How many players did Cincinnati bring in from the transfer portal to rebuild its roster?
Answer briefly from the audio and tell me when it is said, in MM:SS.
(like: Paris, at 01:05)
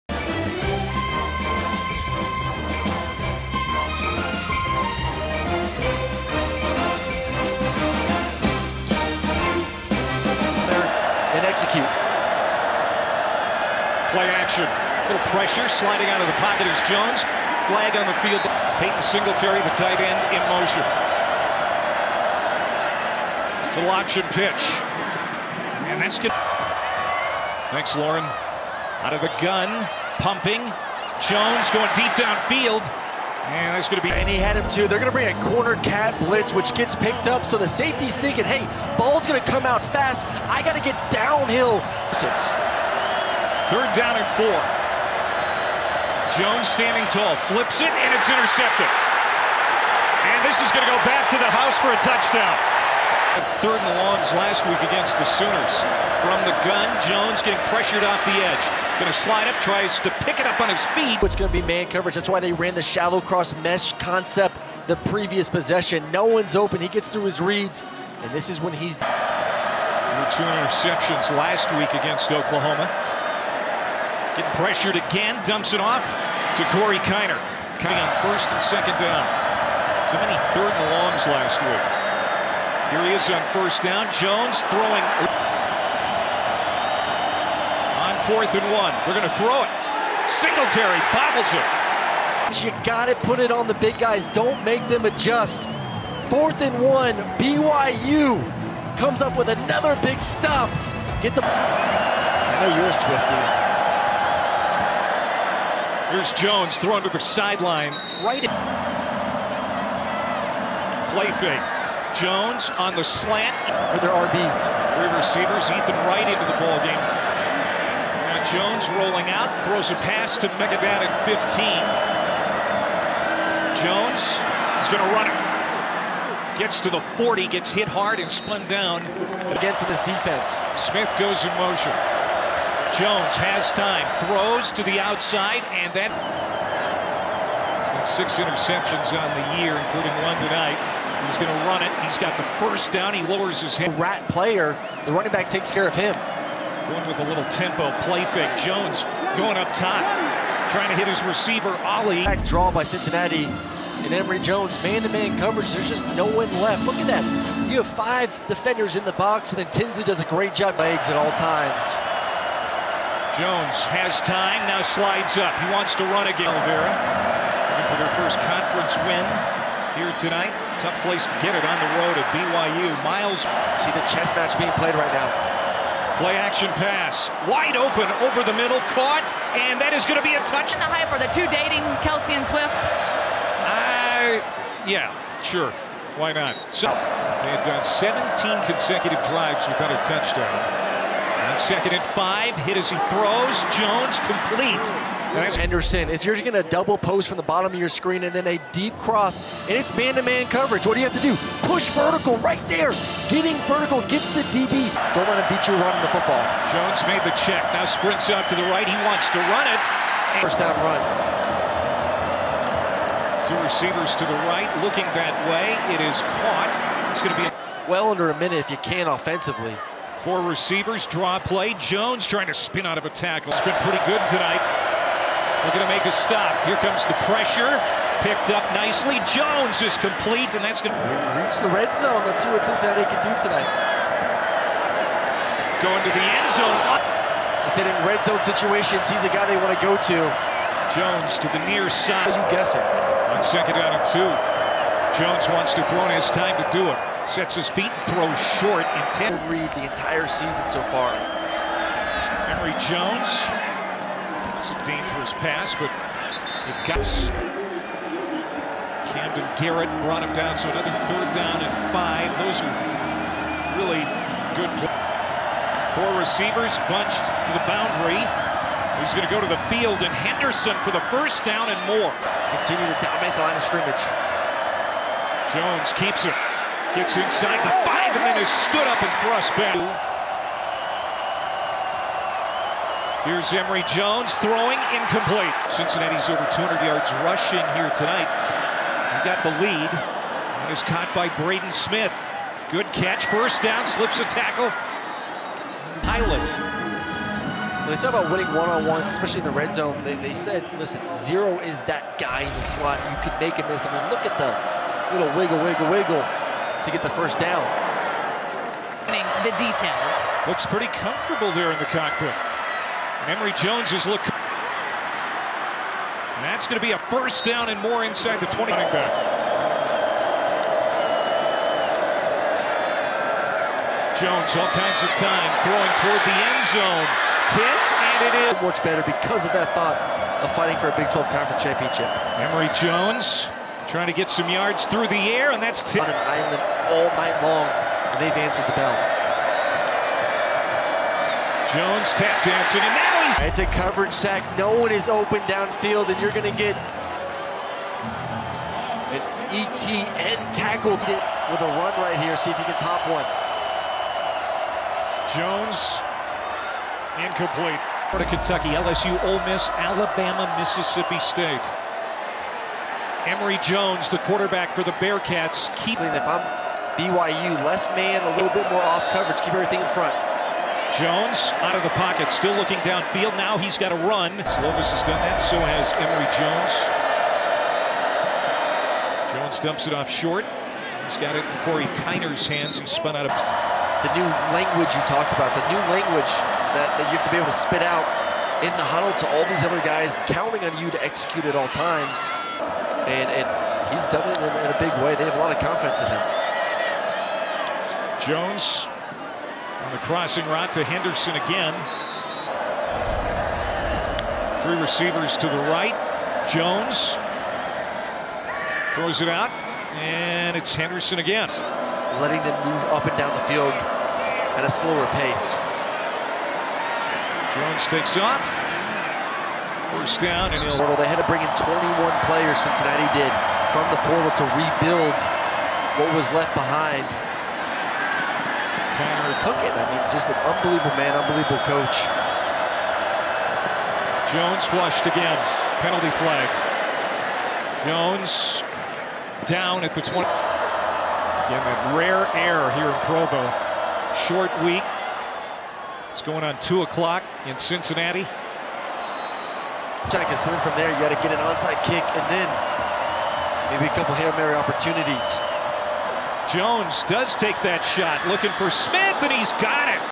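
21, at 07:01.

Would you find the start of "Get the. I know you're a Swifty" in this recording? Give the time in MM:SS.
01:41.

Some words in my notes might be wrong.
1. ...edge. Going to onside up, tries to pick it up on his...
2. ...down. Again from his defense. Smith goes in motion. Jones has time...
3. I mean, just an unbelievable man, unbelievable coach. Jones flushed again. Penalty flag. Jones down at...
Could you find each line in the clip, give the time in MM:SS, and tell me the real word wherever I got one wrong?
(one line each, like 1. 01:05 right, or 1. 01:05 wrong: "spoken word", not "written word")
1. 00:58 wrong: "slide", not "onside"
2. 02:08 right
3. 07:09 right.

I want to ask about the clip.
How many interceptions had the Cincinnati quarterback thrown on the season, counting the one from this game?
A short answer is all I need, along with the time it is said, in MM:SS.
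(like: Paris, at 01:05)
6, at 02:18.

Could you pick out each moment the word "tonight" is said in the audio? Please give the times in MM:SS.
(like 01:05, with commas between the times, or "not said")
02:20, 02:50, 03:44, 03:53, 04:47.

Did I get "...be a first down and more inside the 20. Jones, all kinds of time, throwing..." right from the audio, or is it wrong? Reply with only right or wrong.
right.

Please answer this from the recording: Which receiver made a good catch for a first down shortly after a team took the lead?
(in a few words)
Braden Smith.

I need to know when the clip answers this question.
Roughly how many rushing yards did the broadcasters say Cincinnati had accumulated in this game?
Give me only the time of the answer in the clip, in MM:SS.
04:46.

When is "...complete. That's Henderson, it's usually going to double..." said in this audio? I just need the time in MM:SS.
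03:14.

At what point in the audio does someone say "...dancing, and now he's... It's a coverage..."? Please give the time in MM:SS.
05:42.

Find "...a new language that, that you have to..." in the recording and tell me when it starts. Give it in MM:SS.
06:25.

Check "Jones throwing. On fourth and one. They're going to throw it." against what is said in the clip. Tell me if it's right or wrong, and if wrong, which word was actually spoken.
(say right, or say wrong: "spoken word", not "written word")
right.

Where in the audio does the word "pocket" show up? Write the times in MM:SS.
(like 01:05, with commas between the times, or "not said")
00:16, 06:11.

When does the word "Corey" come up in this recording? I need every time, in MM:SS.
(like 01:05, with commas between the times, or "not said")
01:16, 06:21.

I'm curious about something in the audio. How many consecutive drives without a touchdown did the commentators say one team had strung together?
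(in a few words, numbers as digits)
17.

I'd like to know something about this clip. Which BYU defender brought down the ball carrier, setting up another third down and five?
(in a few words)
Camden Garrett.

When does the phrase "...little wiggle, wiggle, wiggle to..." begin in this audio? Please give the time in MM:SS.
05:05.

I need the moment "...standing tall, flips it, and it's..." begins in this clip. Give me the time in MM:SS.
00:46.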